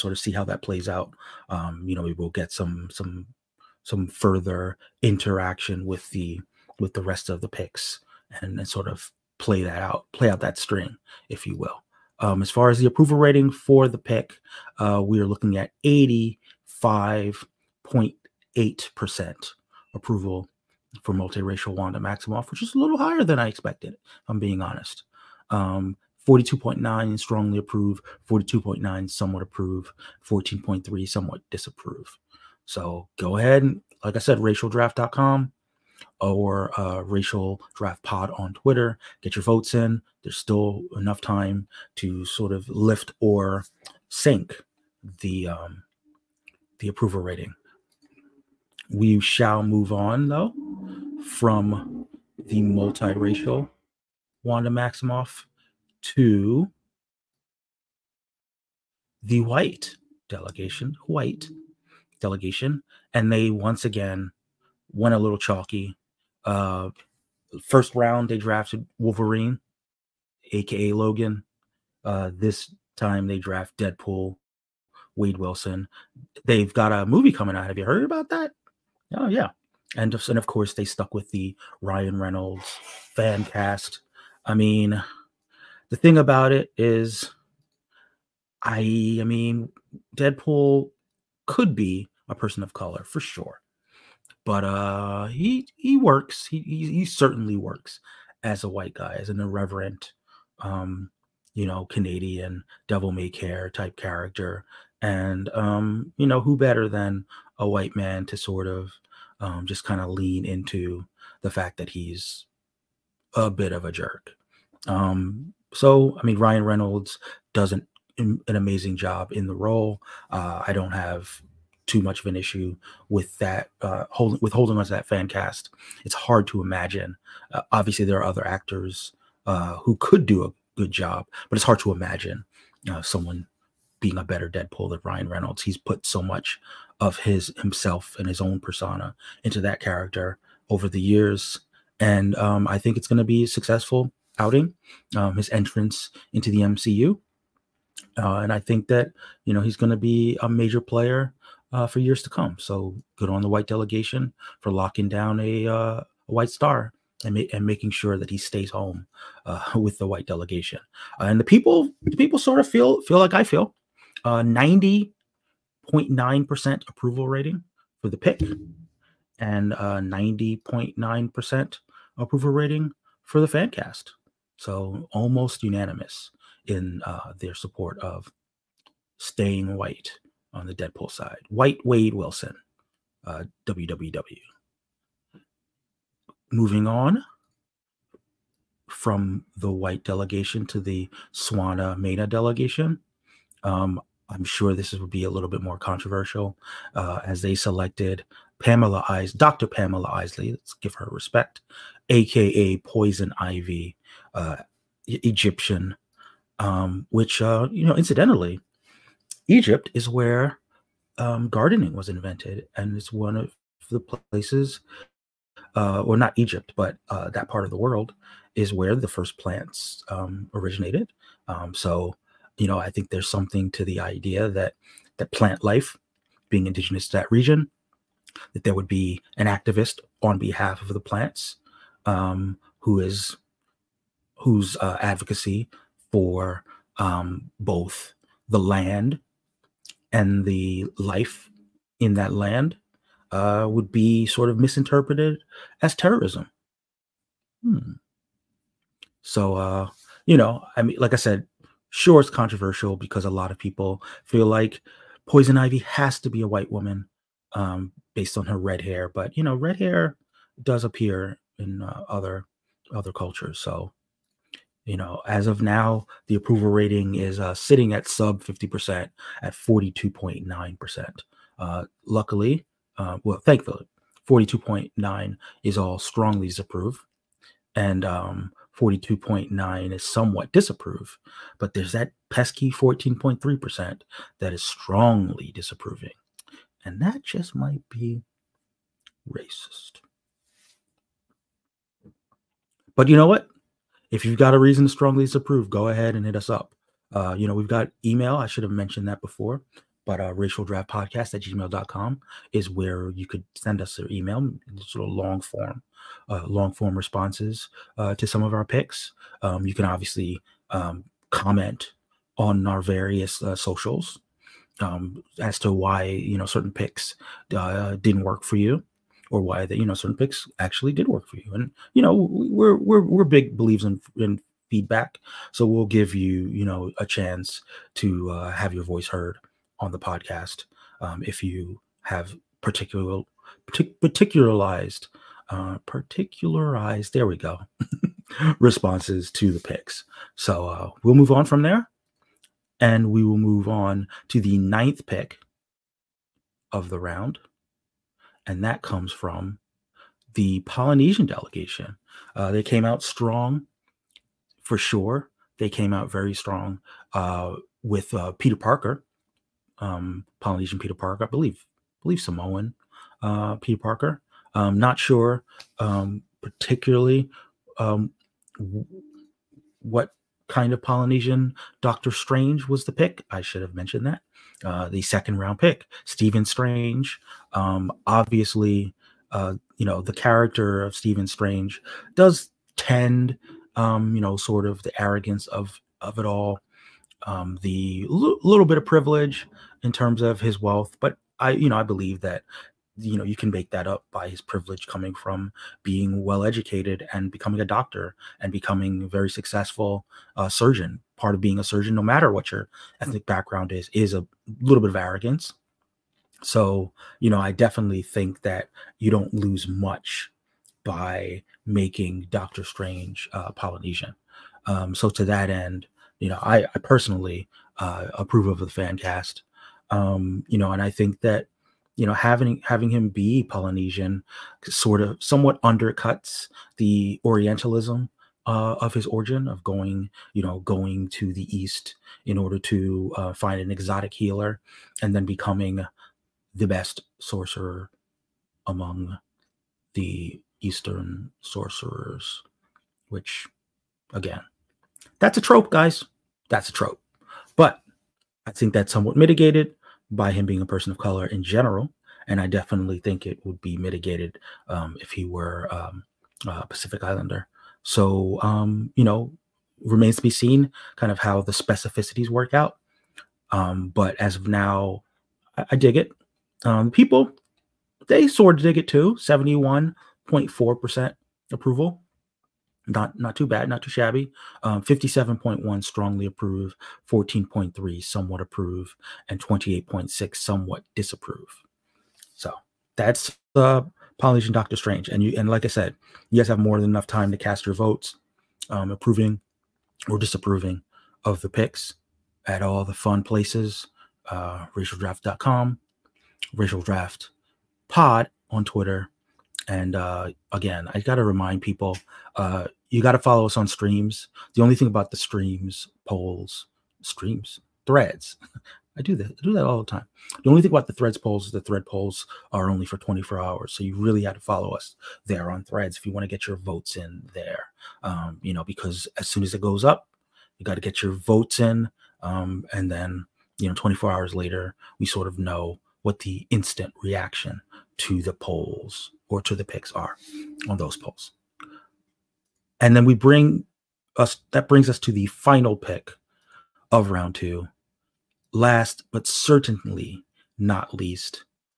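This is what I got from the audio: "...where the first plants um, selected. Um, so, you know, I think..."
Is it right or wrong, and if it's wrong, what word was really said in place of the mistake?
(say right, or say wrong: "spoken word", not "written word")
wrong: "originated", not "selected".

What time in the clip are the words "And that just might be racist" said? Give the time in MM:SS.
04:46.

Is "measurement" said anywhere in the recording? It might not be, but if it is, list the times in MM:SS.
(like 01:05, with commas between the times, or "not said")
not said.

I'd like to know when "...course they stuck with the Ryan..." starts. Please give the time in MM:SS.
01:20.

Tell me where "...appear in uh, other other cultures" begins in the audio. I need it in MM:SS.
04:20.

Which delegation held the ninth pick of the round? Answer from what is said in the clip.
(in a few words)
Polynesian delegation.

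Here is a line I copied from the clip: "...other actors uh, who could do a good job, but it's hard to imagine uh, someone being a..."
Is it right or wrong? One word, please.
right.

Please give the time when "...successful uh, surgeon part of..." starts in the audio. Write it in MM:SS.
06:39.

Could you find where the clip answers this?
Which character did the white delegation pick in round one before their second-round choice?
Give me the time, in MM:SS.
01:08.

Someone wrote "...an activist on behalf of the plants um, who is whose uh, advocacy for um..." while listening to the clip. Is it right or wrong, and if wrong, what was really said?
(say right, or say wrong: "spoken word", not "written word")
right.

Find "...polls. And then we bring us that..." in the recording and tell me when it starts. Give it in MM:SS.
08:50.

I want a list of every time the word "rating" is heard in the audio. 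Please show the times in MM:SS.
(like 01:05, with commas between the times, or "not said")
00:13, 00:47, 02:47, 02:52, 04:26.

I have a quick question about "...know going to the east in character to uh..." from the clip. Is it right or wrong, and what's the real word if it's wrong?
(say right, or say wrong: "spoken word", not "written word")
wrong: "order", not "character".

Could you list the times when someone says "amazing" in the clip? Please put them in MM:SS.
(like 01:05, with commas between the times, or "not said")
01:58.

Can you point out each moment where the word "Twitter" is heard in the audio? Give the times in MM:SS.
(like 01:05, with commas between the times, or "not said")
00:38, 08:18.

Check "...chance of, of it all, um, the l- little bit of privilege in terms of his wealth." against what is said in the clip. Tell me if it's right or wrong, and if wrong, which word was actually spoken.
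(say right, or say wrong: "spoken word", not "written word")
wrong: "arrogance", not "chance".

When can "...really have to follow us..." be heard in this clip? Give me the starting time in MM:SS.
08:33.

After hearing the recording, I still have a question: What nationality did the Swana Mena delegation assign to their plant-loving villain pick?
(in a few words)
Egyptian.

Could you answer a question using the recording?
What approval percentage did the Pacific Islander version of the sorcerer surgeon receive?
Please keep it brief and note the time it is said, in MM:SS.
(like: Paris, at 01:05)
71.4%, at 07:49.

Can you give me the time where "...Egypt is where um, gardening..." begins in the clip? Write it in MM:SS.
03:29.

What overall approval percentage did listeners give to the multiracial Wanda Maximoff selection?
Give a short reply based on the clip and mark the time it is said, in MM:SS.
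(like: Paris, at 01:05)
85.8%, at 00:15.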